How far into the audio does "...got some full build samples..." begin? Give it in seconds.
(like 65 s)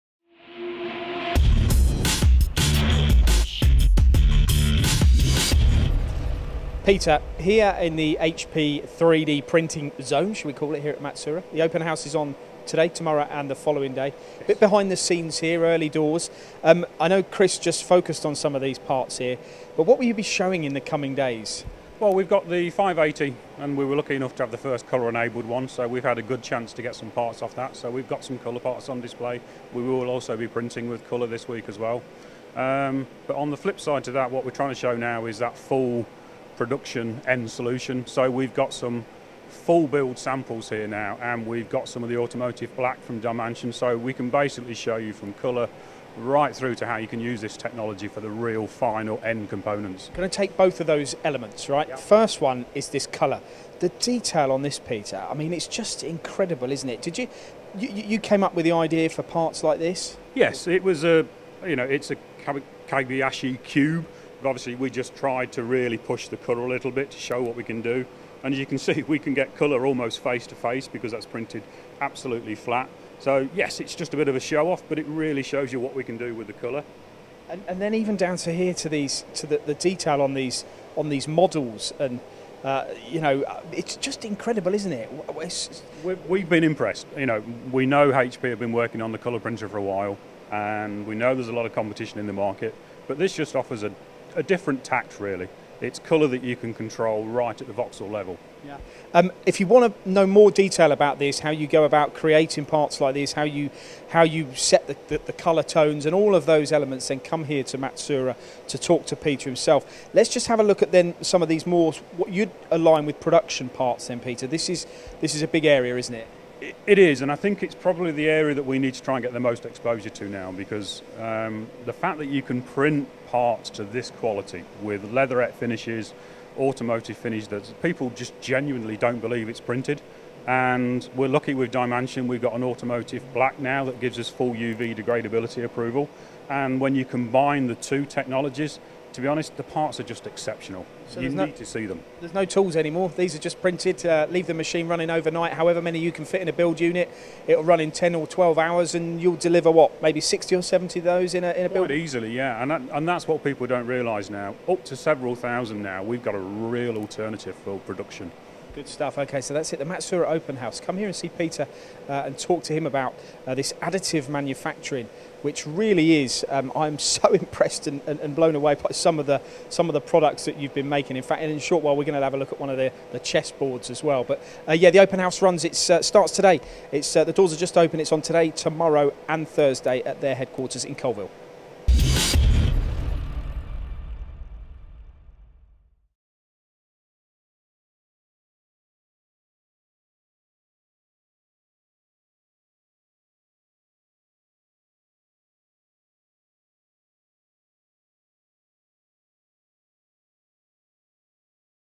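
38 s.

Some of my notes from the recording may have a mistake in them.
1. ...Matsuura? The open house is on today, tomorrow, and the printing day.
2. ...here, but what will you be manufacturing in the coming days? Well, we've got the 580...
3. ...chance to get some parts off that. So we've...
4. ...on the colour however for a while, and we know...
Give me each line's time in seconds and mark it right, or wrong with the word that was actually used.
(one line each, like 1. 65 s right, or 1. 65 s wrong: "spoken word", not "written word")
1. 10 s wrong: "following", not "printing"
2. 19 s wrong: "showing", not "manufacturing"
3. 26 s right
4. 89 s wrong: "printer", not "however".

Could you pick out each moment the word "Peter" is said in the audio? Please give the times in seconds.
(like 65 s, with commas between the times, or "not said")
6 s, 54 s, 109 s, 114 s, 161 s.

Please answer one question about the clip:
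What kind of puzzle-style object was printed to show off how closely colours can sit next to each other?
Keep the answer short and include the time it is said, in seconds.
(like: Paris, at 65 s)
Kagayashi cube, at 62 s.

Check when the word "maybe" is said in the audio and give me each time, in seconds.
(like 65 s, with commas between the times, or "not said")
150 s.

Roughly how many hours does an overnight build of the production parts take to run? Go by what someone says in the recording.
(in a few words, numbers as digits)
10 or 12 hours.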